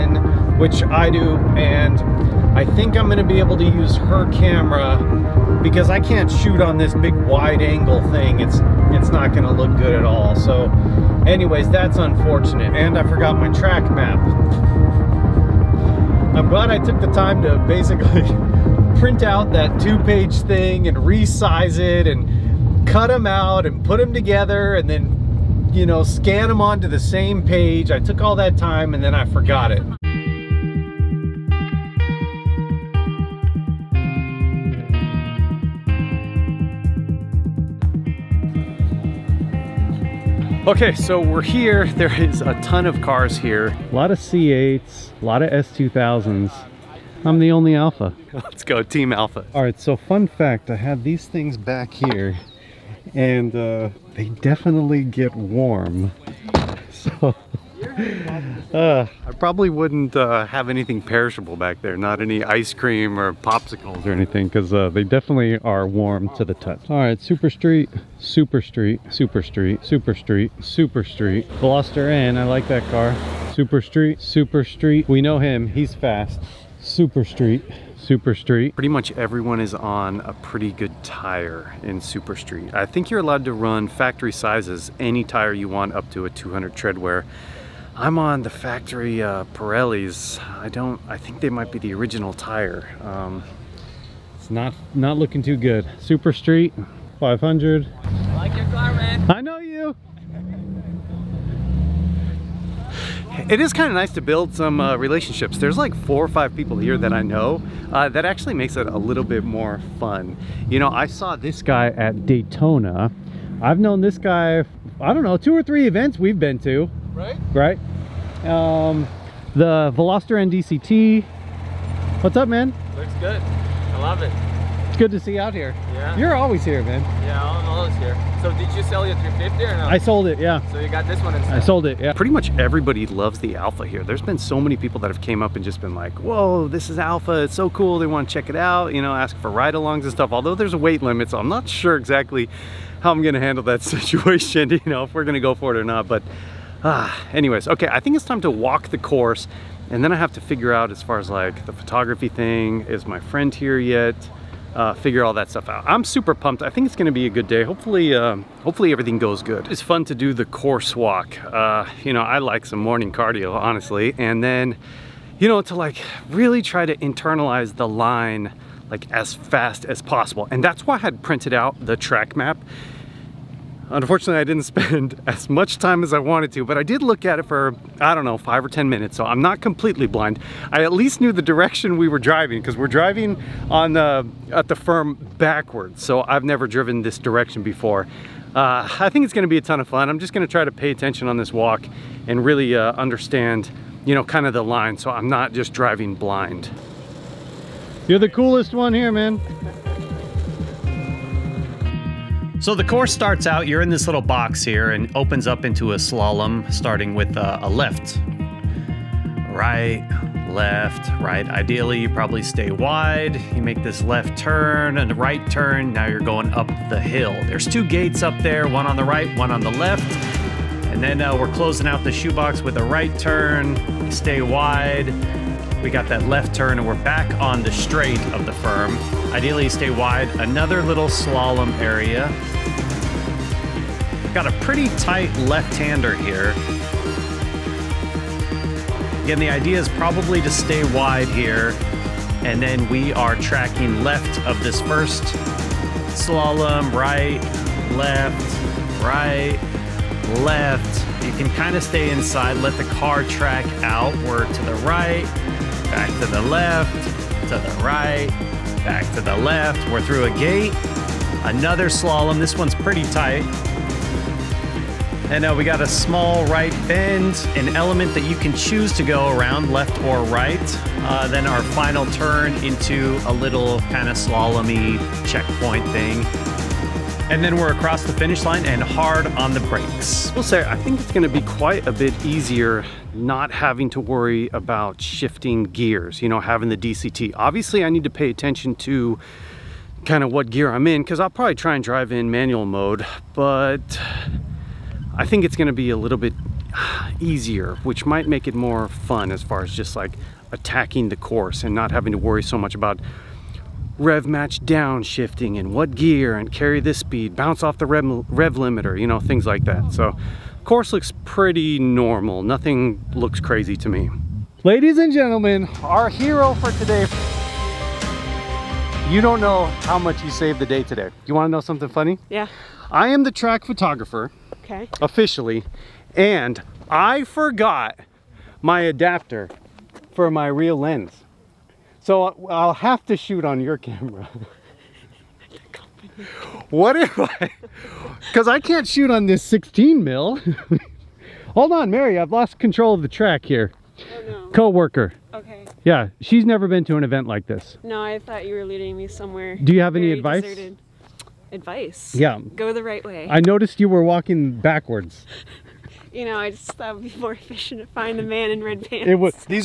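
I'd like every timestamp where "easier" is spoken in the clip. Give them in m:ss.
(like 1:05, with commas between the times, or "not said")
4:42, 4:57.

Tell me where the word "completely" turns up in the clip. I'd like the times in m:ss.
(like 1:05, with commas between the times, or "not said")
2:59.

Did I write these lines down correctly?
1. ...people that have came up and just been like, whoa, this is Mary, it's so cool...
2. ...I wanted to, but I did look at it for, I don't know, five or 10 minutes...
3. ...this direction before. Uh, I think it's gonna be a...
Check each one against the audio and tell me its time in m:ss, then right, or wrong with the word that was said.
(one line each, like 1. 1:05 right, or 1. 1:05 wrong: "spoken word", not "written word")
1. 2:14 wrong: "Alfa", not "Mary"
2. 2:56 right
3. 3:07 right.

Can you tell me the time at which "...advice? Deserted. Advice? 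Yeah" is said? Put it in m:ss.
5:50.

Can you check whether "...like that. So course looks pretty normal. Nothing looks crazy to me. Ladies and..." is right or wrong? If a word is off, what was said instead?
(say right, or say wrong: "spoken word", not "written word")
right.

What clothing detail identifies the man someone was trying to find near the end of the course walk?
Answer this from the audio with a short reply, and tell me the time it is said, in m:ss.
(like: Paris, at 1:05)
red pants, at 5:58.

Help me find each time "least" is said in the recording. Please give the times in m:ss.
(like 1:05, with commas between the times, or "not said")
3:00.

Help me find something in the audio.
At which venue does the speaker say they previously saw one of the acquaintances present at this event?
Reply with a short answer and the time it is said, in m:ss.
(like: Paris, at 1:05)
Daytona, at 1:52.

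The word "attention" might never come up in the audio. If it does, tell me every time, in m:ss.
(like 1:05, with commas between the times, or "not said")
3:10, 4:48.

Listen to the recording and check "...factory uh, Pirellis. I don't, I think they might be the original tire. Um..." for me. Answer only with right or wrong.
right.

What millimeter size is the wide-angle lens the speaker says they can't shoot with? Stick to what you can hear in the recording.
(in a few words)
16.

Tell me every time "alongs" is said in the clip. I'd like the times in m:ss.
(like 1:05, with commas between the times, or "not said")
2:19.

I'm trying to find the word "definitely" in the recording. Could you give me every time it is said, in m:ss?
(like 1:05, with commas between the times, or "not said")
0:54, 1:05.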